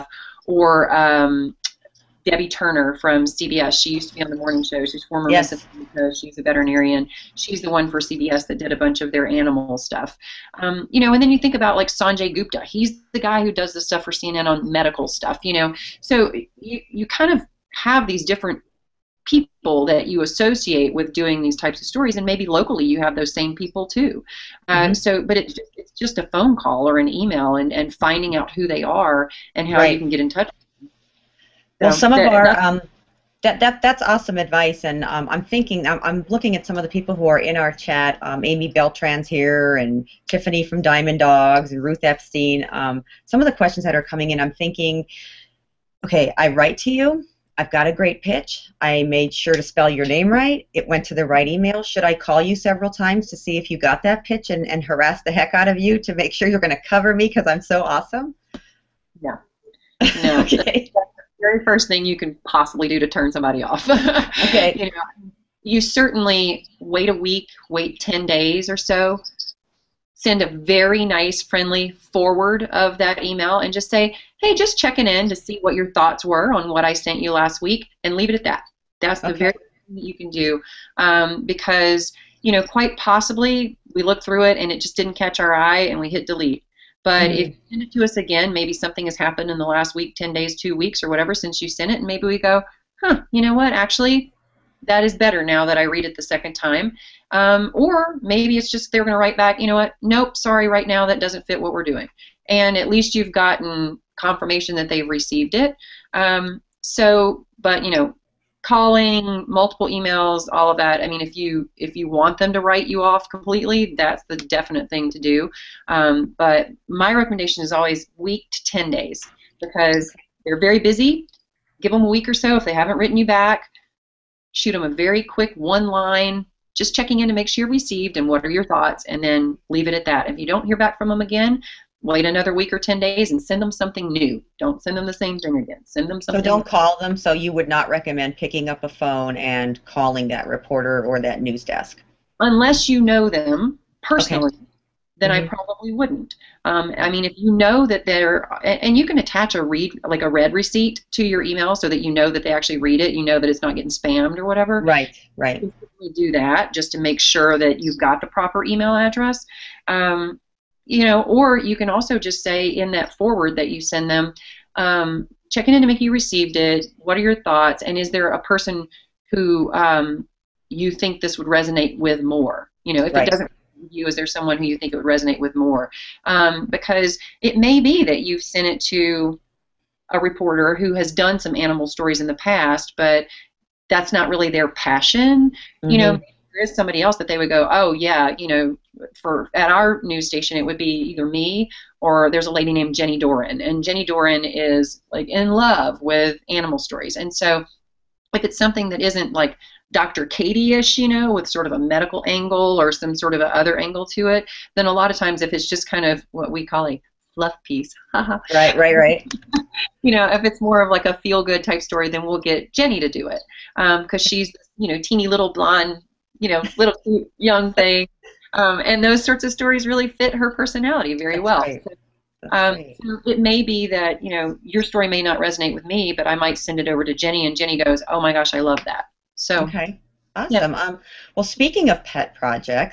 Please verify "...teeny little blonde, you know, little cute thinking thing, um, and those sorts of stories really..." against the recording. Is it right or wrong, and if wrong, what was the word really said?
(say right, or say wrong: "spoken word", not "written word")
wrong: "young", not "thinking".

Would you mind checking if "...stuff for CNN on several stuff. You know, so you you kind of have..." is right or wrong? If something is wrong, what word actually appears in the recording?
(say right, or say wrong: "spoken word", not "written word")
wrong: "medical", not "several".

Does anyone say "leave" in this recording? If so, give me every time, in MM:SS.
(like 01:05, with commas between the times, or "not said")
01:18, 02:09.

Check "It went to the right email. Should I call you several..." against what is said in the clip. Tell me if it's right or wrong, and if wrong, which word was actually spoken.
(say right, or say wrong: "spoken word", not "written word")
right.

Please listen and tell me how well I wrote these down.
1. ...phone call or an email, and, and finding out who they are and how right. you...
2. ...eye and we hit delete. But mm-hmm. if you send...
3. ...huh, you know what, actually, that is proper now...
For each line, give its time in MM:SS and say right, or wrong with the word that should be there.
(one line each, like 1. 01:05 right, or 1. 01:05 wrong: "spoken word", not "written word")
1. 00:26 right
2. 01:25 right
3. 01:33 wrong: "better", not "proper".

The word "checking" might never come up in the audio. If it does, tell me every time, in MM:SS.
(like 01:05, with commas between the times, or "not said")
01:14, 02:06, 02:45.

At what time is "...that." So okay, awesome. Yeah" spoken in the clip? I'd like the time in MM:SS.
03:48.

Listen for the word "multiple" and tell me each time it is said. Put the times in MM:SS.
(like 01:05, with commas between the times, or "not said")
01:49.